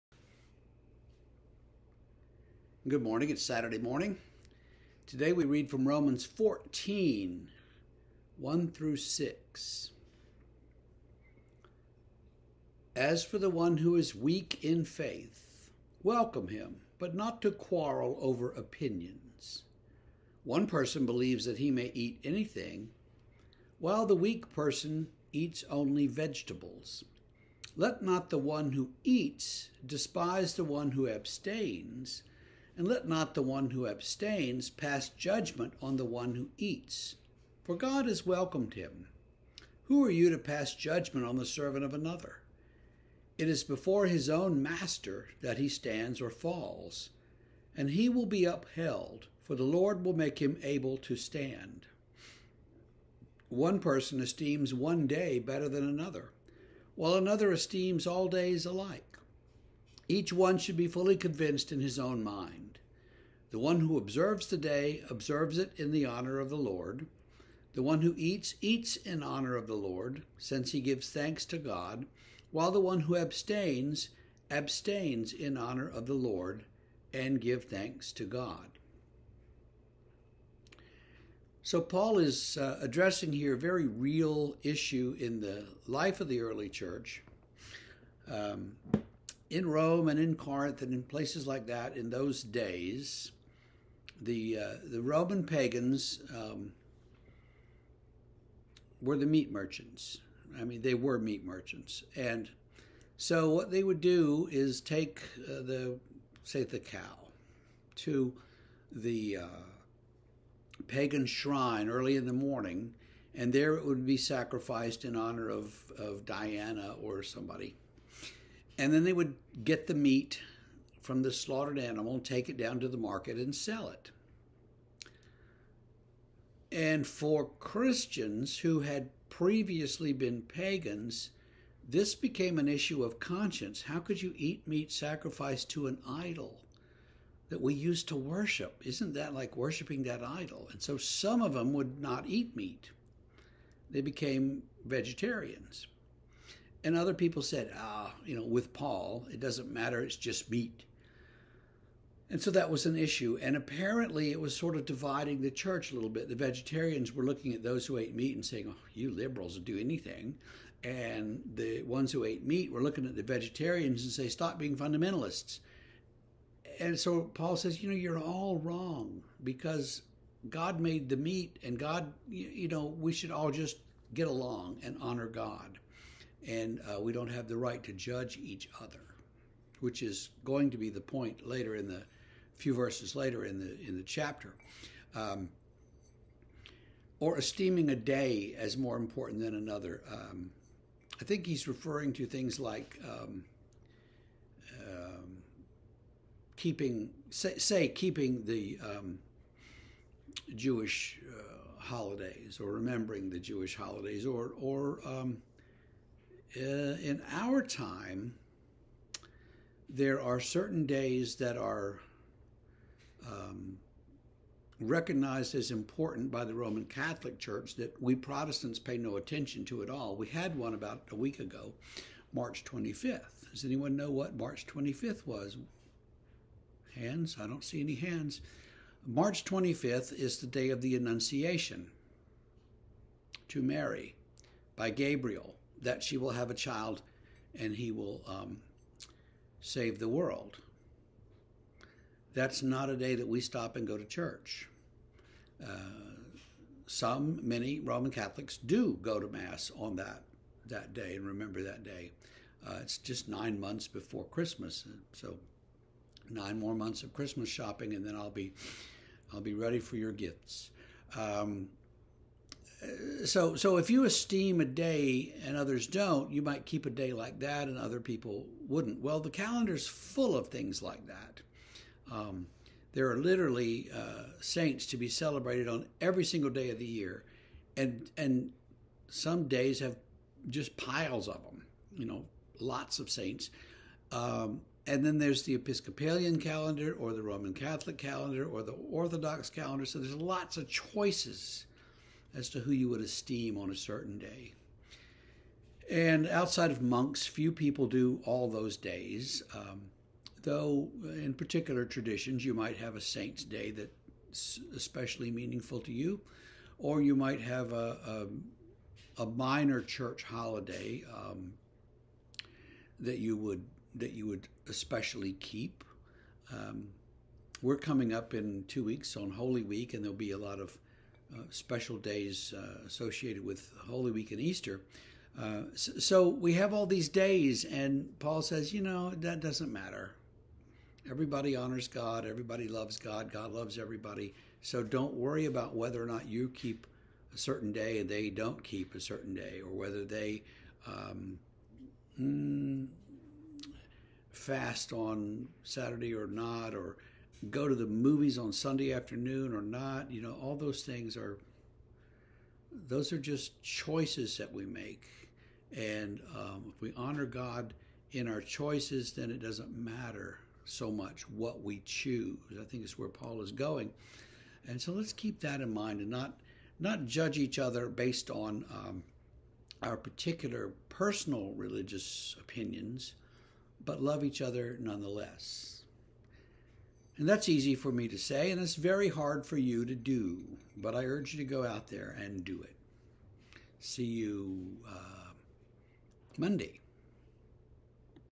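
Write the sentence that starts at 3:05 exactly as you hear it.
Um, or esteeming a day as more important than another.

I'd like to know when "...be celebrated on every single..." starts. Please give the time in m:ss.
4:34.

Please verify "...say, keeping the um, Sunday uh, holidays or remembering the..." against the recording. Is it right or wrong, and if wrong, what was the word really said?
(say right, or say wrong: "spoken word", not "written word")
wrong: "Jewish", not "Sunday".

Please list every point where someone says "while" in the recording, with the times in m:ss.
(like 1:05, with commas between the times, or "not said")
0:23, 0:56, 1:12.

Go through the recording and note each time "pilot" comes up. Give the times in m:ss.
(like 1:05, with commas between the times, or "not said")
not said.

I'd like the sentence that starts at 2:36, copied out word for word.
The vegetarians were looking at those who ate meat and saying, oh, you liberals do anything.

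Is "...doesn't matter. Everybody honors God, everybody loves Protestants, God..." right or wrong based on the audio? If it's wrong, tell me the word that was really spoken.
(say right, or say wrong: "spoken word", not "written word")
wrong: "God", not "Protestants".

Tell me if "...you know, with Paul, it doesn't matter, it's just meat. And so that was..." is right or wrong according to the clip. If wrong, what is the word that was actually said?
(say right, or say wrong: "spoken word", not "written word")
right.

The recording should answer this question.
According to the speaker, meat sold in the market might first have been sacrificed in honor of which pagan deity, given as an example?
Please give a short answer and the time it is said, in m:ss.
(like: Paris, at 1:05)
Diana, at 1:56.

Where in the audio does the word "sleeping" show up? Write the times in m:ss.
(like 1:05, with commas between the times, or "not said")
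not said.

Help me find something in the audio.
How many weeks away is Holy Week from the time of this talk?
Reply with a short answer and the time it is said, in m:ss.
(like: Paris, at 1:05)
2, at 5:18.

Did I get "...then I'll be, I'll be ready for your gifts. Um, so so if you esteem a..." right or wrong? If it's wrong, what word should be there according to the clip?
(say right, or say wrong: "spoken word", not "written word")
right.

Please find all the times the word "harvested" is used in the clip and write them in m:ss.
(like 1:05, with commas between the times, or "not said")
not said.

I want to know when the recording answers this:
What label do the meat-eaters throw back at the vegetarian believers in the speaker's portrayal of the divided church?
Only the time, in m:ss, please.
2:44.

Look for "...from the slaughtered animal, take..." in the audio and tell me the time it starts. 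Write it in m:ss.
2:01.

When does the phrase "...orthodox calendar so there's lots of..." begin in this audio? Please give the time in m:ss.
4:48.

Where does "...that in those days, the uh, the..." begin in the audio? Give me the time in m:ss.
1:31.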